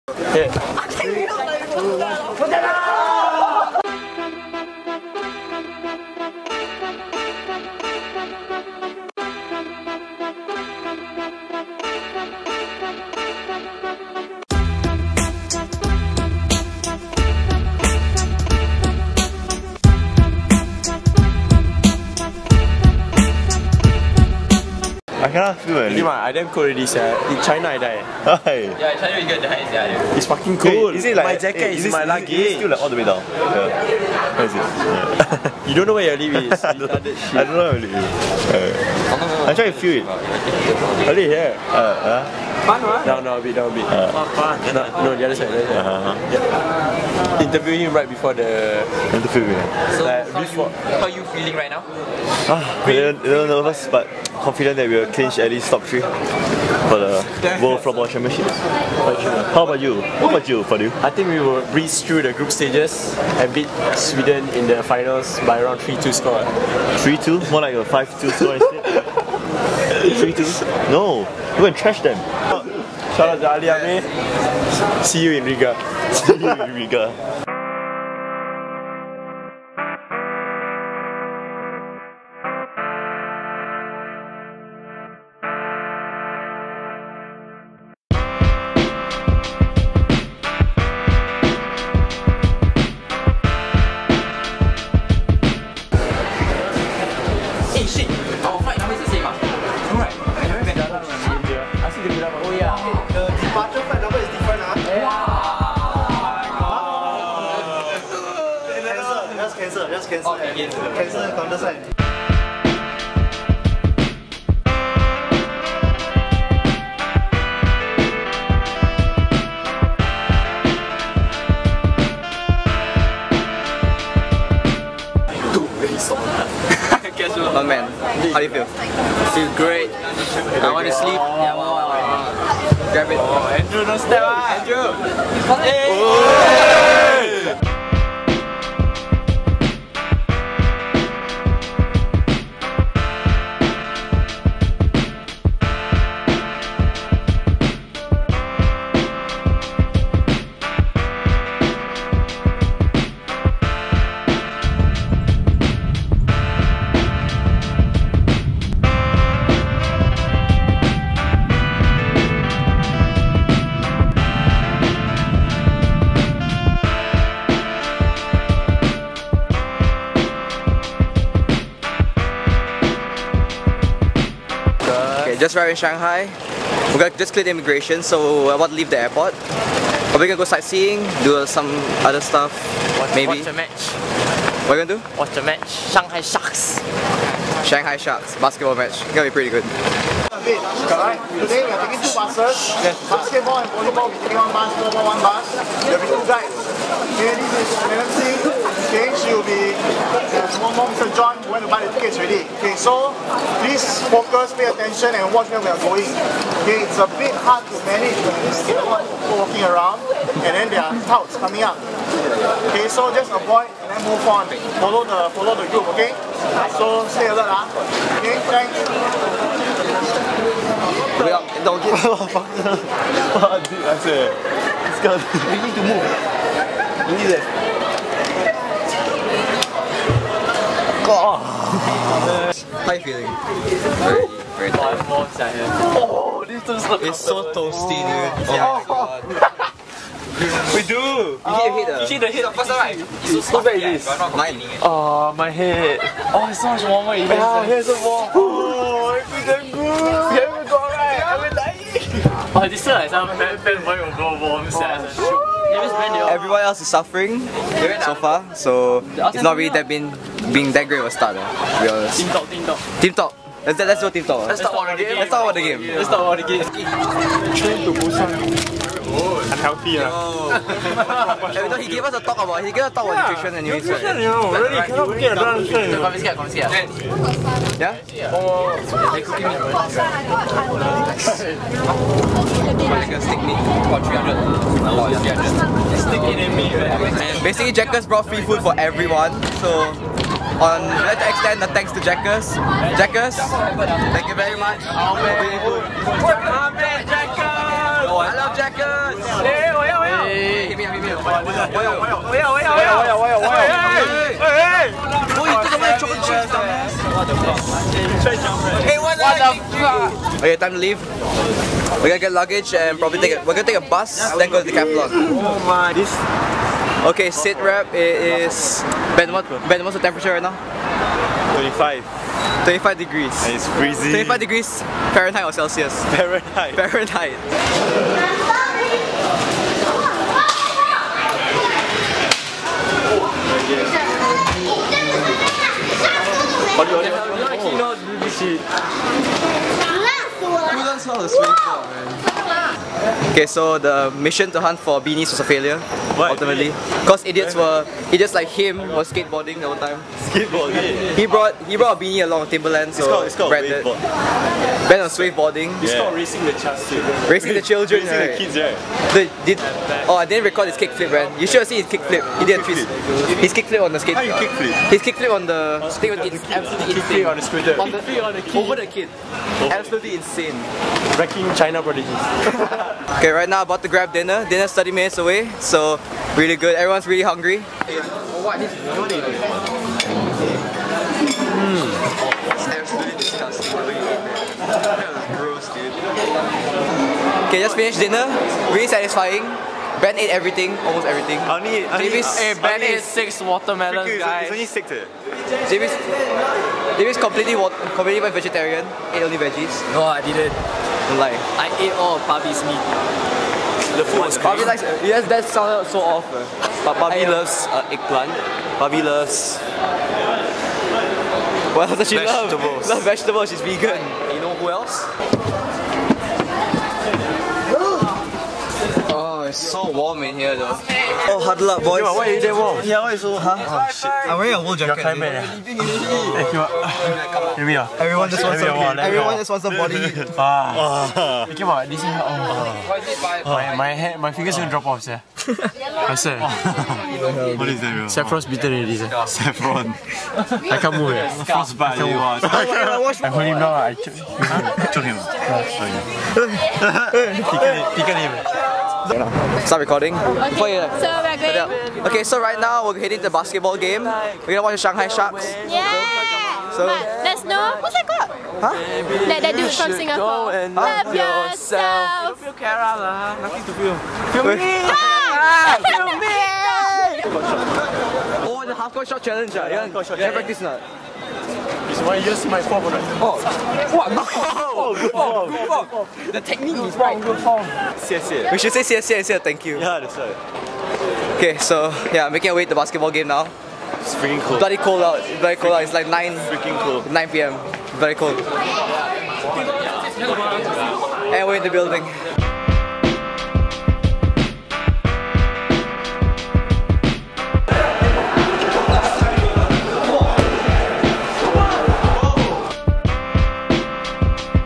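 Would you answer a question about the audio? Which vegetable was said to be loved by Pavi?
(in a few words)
eggplant.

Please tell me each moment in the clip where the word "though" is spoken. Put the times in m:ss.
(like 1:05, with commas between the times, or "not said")
4:31, 7:00.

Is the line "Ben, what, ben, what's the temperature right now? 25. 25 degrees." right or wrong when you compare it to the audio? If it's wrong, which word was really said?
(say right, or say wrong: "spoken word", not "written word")
right.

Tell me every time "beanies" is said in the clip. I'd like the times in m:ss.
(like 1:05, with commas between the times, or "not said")
5:44, 5:52.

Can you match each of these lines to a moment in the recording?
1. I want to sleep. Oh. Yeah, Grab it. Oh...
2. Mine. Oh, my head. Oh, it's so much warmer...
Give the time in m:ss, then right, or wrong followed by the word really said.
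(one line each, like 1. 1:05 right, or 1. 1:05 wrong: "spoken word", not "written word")
1. 2:10 right
2. 4:04 right.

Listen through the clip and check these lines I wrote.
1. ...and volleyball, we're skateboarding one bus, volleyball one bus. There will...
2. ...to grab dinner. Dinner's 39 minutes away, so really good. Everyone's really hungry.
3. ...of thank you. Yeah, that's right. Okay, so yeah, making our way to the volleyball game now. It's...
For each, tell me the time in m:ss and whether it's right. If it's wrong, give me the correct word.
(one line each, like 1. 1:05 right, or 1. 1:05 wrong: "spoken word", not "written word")
1. 3:13 wrong: "taking", not "skateboarding"
2. 6:13 wrong: "30", not "39"
3. 7:59 wrong: "basketball", not "volleyball".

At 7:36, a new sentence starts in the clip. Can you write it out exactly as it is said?
So but let's know what's that called?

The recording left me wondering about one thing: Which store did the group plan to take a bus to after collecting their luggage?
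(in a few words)
Decathlon.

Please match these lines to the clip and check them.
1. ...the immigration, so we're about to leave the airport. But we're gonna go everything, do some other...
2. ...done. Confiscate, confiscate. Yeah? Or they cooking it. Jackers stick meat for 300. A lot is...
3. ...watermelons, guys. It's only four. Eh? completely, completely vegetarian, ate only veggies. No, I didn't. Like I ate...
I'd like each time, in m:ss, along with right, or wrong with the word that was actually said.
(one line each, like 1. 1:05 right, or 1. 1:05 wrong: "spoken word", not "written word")
1. 2:57 wrong: "sightseeing", not "everything"
2. 4:35 right
3. 6:33 wrong: "six", not "four".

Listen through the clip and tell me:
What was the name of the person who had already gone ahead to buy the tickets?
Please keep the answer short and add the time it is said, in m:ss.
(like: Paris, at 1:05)
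Mr. John, at 3:20.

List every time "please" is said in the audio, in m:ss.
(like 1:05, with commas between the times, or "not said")
3:23.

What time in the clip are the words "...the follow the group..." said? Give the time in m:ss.
3:35.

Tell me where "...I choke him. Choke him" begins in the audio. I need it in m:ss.
7:23.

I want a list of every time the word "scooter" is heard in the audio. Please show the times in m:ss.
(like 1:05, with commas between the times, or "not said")
6:07.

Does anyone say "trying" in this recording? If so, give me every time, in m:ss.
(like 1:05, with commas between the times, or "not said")
0:39.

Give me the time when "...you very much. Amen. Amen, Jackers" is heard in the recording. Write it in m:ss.
4:54.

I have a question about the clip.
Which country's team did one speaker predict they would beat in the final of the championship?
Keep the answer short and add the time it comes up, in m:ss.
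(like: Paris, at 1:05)
Sweden, at 1:03.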